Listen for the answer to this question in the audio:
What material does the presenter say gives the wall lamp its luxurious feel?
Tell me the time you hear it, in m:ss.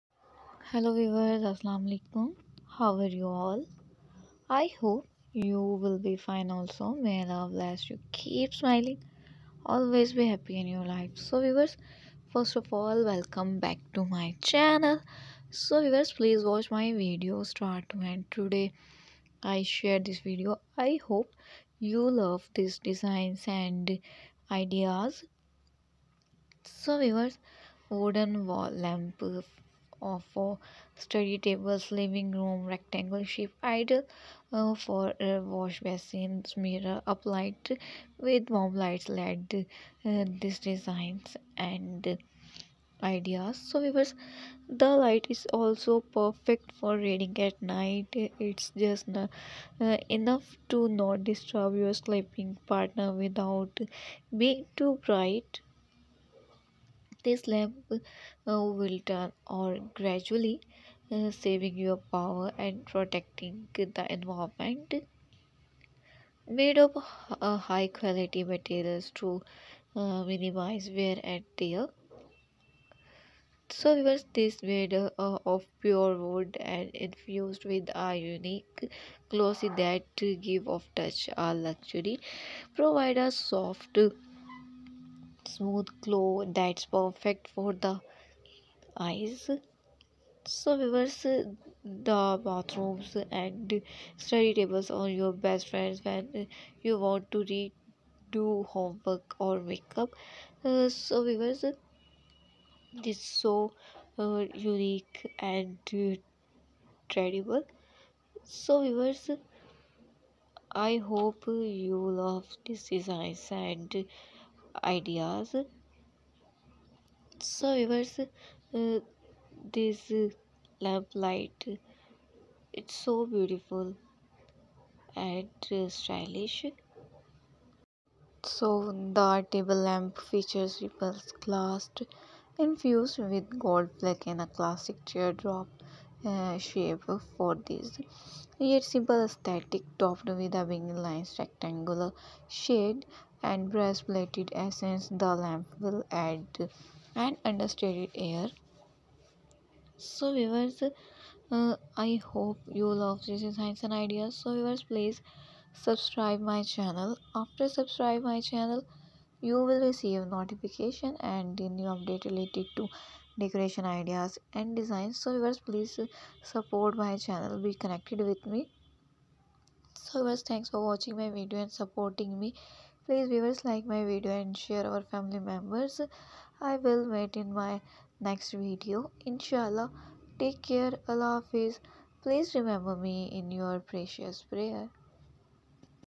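1:15.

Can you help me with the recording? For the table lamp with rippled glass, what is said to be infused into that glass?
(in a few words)
Gold flake.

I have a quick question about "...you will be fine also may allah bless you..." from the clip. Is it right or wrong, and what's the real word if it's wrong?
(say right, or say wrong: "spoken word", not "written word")
right.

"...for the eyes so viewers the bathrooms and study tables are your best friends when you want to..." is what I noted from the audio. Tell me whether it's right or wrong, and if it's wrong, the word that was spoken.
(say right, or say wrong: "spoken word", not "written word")
right.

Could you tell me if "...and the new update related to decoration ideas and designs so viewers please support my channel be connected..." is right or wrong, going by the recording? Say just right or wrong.
right.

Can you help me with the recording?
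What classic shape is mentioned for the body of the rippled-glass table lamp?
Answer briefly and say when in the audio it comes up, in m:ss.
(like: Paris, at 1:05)
Teardrop, at 2:15.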